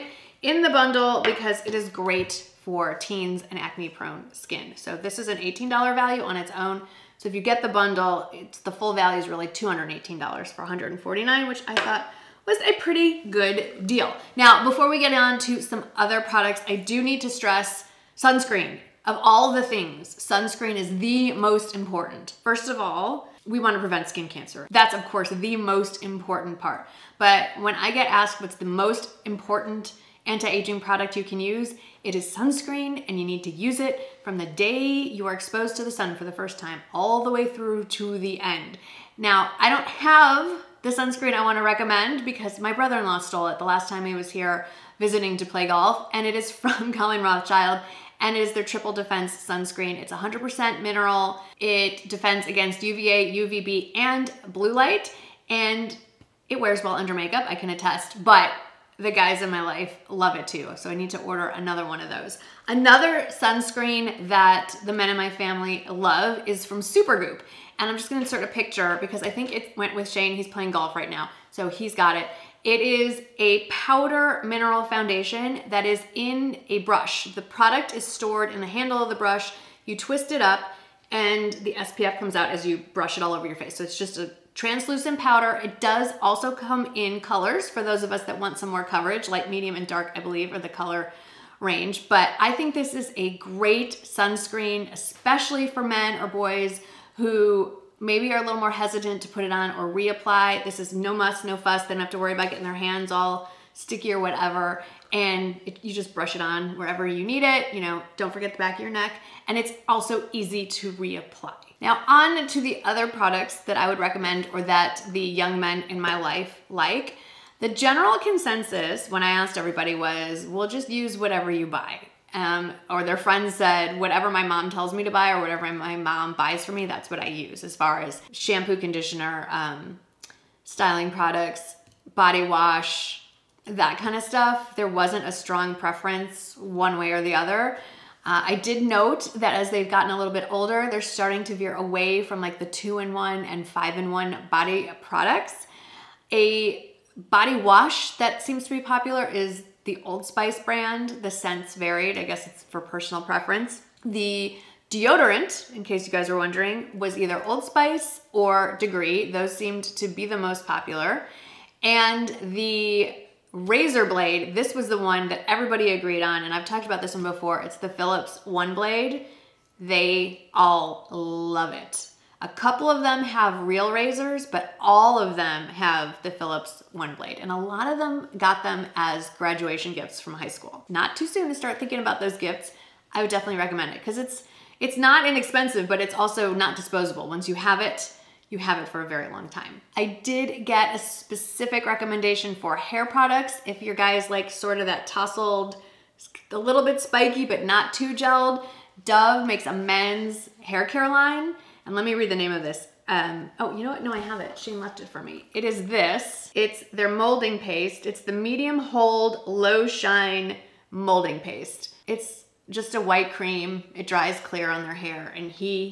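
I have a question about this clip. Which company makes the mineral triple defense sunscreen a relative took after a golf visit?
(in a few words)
Colleen Rothschild.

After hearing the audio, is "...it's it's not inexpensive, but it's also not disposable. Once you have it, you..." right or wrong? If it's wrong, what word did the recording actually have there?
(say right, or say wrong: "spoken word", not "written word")
right.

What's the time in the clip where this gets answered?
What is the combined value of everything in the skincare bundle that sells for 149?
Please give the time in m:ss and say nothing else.
0:09.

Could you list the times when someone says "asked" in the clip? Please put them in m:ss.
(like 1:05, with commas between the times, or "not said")
0:28, 1:59.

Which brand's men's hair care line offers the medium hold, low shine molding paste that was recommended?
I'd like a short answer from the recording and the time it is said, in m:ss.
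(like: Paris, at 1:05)
Dove, at 3:19.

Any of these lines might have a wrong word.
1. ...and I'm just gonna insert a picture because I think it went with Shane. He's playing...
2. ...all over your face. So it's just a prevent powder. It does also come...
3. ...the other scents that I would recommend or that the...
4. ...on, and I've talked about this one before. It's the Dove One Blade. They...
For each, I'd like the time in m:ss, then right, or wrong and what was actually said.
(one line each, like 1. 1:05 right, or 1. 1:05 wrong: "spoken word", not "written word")
1. 1:07 right
2. 1:23 wrong: "translucent", not "prevent"
3. 1:52 wrong: "products", not "scents"
4. 2:46 wrong: "Philips", not "Dove".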